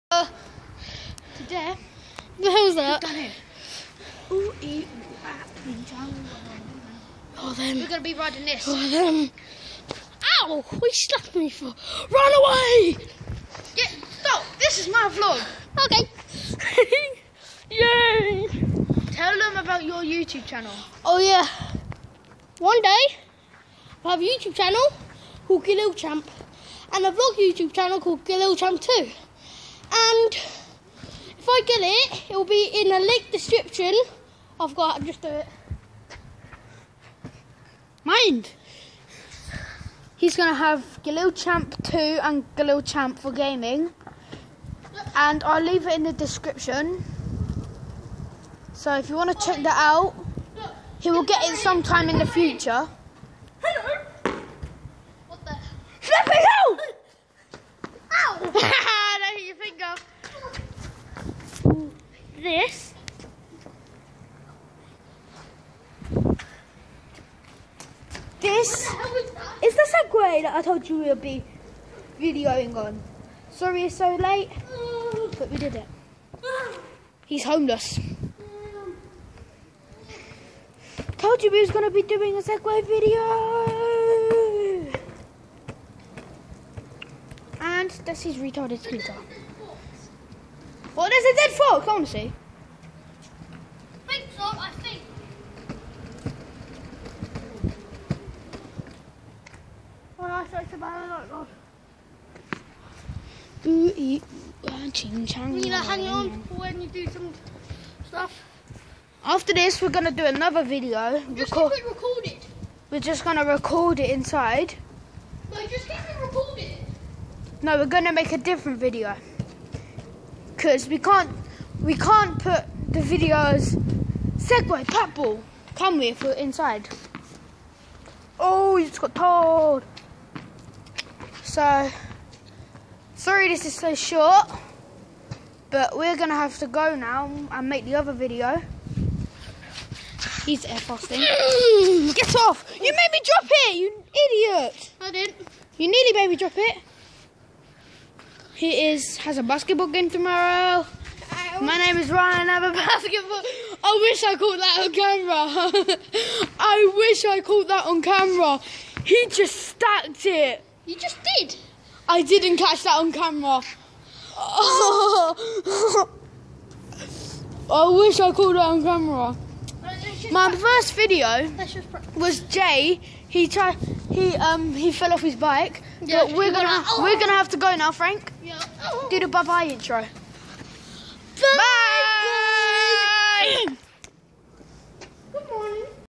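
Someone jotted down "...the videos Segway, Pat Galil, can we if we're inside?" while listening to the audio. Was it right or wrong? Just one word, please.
wrong.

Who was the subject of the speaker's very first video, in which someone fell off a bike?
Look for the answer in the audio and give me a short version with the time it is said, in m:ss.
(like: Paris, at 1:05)
Jay, at 2:52.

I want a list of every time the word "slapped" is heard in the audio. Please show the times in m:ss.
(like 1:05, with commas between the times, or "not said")
0:10.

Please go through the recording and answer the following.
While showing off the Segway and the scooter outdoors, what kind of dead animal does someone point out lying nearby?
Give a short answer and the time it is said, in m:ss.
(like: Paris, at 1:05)
Frog, at 1:31.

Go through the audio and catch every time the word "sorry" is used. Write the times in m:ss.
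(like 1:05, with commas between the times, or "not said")
1:13, 2:13.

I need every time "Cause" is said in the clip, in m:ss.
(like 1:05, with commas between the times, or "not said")
2:00.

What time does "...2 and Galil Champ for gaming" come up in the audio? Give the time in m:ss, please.
0:41.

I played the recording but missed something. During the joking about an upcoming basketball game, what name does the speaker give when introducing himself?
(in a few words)
Ryan.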